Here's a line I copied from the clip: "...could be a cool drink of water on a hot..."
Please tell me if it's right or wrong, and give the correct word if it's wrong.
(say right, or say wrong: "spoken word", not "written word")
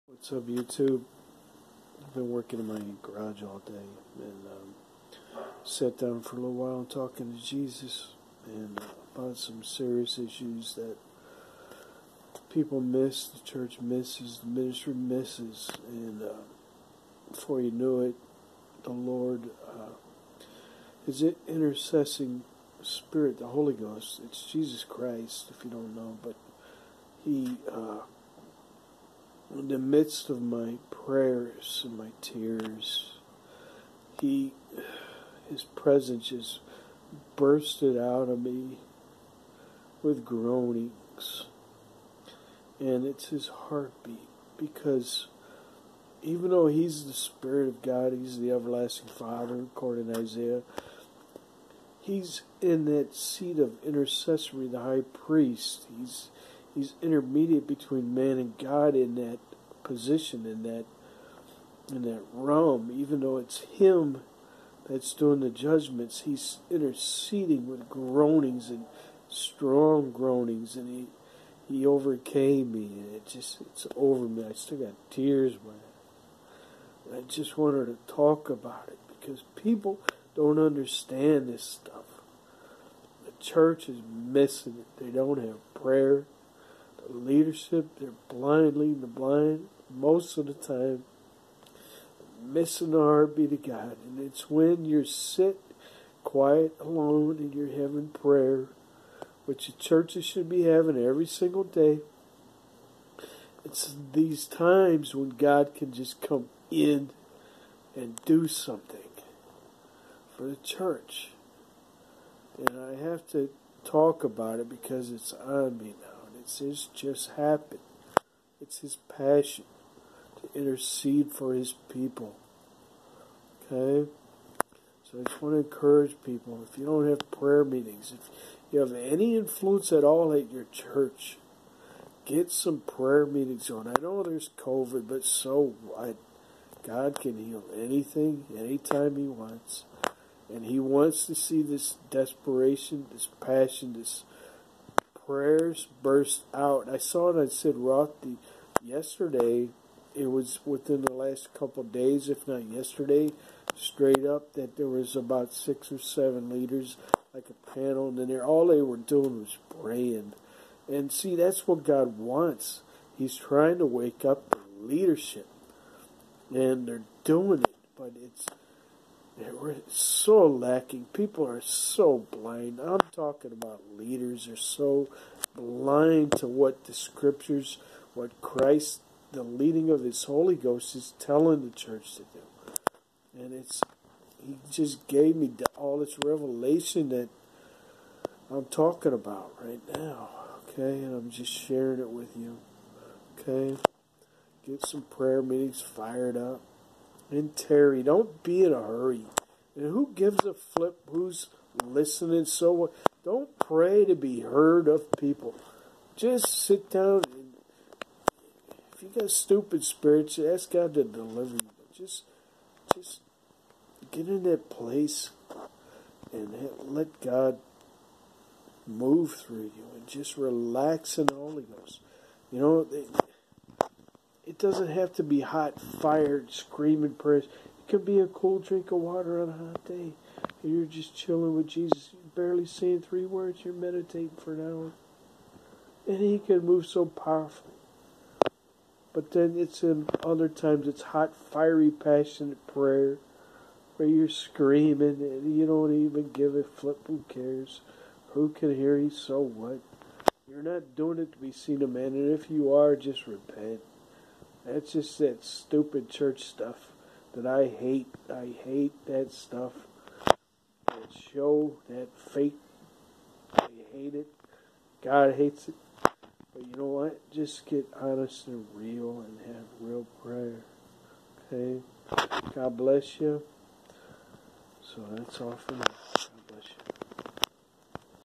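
right.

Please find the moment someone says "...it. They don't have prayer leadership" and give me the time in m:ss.
1:24.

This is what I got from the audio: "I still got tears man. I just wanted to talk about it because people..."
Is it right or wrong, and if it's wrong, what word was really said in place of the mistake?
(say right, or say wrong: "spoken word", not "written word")
right.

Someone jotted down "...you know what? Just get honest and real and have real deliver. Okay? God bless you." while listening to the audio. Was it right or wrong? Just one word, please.
wrong.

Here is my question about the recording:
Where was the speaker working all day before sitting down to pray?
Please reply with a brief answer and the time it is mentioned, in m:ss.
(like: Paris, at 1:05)
Garage, at 0:03.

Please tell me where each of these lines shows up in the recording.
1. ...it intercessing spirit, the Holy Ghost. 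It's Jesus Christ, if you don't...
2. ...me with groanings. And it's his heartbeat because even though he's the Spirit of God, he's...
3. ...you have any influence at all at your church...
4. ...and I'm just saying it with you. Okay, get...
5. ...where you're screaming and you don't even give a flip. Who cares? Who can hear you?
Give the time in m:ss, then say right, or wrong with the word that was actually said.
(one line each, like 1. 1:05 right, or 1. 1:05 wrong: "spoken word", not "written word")
1. 0:21 right
2. 0:38 right
3. 2:08 right
4. 3:11 wrong: "sharing", not "saying"
5. 4:03 right.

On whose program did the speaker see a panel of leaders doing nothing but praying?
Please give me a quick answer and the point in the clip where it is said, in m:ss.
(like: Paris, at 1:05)
Sid Roth, at 2:27.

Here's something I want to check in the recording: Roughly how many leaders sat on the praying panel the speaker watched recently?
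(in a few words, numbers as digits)
6 or 7.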